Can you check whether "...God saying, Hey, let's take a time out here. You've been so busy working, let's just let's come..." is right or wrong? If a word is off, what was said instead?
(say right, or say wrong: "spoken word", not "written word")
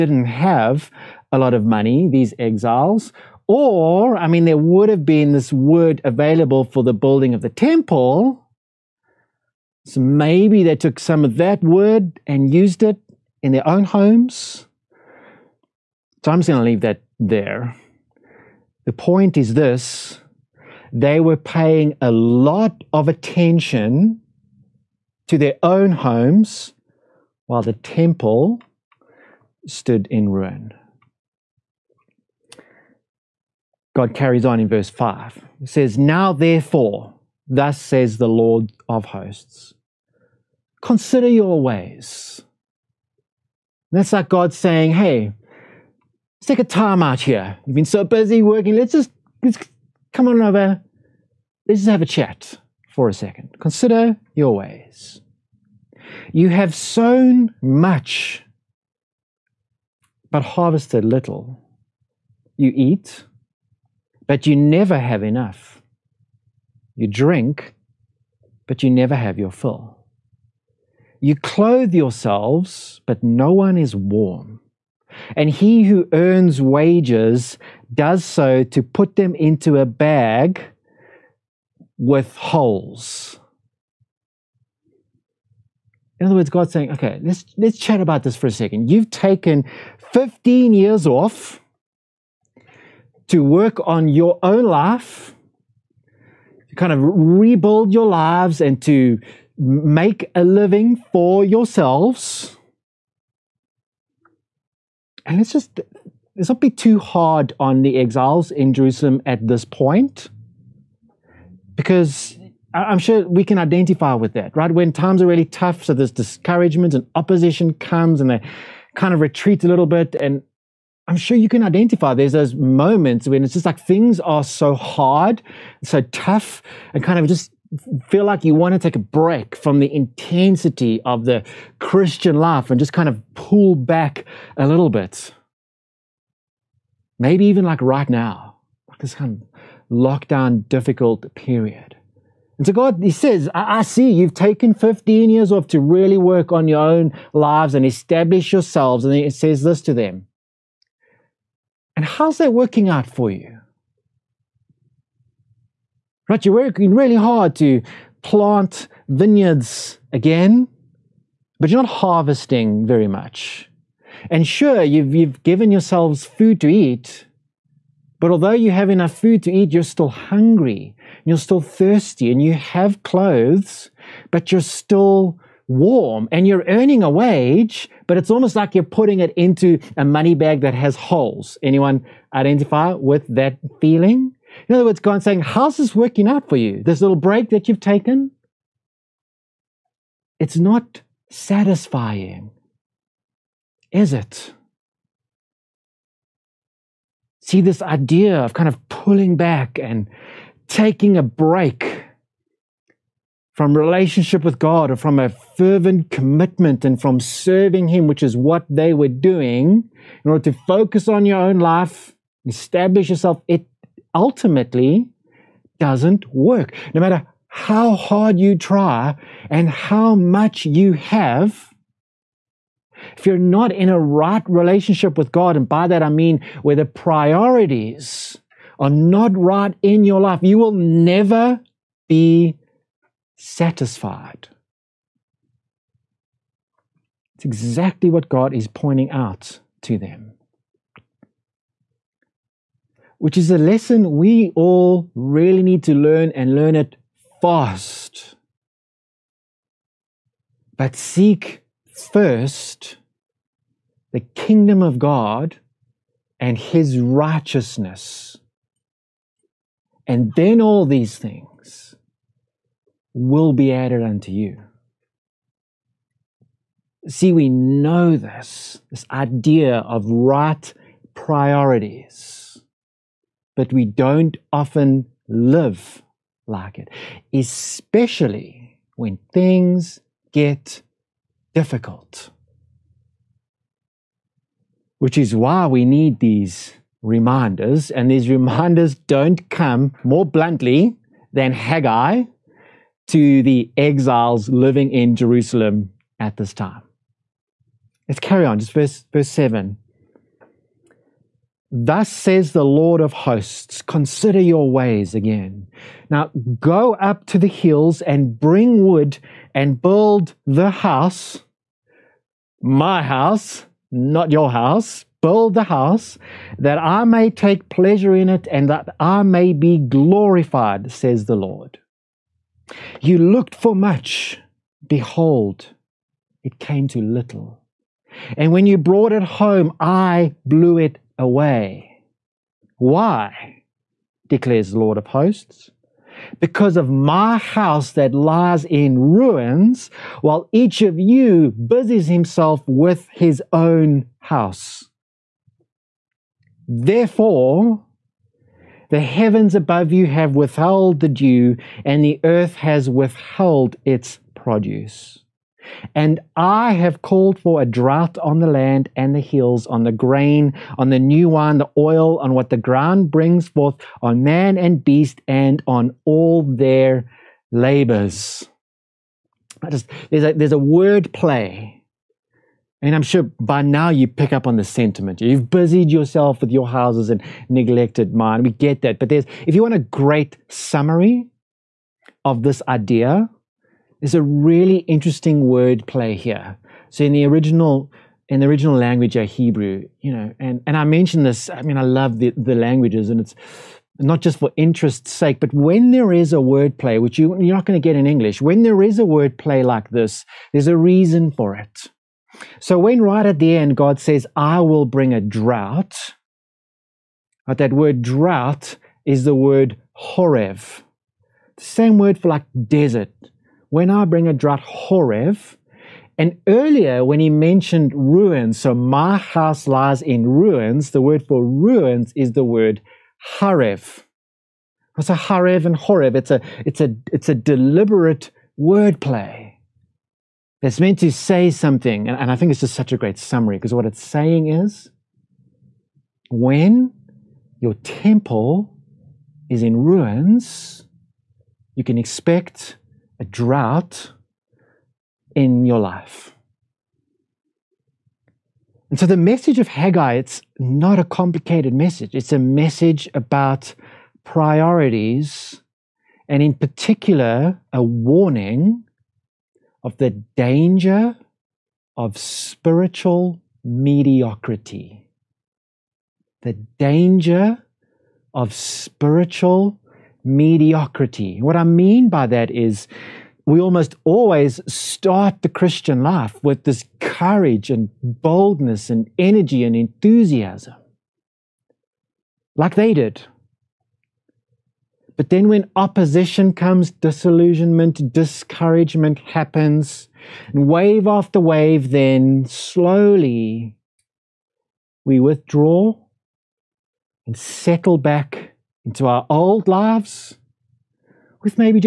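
right.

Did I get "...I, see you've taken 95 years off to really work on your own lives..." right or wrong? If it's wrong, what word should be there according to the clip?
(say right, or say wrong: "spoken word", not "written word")
wrong: "15", not "95".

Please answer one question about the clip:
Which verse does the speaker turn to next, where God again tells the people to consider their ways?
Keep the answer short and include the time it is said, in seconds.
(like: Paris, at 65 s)
Verse 7, at 299 s.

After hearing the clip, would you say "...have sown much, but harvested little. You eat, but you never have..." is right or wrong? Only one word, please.
right.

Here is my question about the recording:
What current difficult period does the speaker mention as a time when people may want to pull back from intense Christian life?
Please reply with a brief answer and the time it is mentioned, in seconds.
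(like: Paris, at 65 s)
lockdown, at 139 s.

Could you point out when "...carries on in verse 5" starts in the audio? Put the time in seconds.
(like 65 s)
34 s.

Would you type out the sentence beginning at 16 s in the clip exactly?
So I'm just going to leave that there.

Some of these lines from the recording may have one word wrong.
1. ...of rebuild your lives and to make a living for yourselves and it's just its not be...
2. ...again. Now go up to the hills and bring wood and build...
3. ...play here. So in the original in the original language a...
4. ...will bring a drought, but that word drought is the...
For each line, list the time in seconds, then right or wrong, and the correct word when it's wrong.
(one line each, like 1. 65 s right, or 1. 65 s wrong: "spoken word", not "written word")
1. 96 s right
2. 305 s right
3. 385 s right
4. 404 s right.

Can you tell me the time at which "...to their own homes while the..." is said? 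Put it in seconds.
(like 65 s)
25 s.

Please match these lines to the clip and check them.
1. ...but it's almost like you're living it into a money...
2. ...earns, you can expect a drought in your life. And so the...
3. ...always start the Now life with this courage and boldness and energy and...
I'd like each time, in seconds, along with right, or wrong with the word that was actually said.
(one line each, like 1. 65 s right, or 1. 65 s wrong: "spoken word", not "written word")
1. 178 s wrong: "putting", not "living"
2. 439 s wrong: "ruins", not "earns"
3. 474 s wrong: "Christian", not "Now".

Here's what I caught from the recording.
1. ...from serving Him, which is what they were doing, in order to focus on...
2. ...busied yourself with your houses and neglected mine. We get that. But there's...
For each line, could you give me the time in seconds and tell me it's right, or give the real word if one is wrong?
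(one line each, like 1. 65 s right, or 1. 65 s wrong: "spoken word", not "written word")
1. 206 s right
2. 375 s right.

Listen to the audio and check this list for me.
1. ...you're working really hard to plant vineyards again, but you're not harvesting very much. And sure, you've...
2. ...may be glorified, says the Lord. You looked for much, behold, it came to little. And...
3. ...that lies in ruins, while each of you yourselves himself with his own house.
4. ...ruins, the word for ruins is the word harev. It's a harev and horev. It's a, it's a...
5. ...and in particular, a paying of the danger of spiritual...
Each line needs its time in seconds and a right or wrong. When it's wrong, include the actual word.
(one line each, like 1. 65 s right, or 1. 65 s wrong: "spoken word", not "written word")
1. 156 s right
2. 319 s right
3. 337 s wrong: "busies", not "yourselves"
4. 420 s right
5. 456 s wrong: "warning", not "paying".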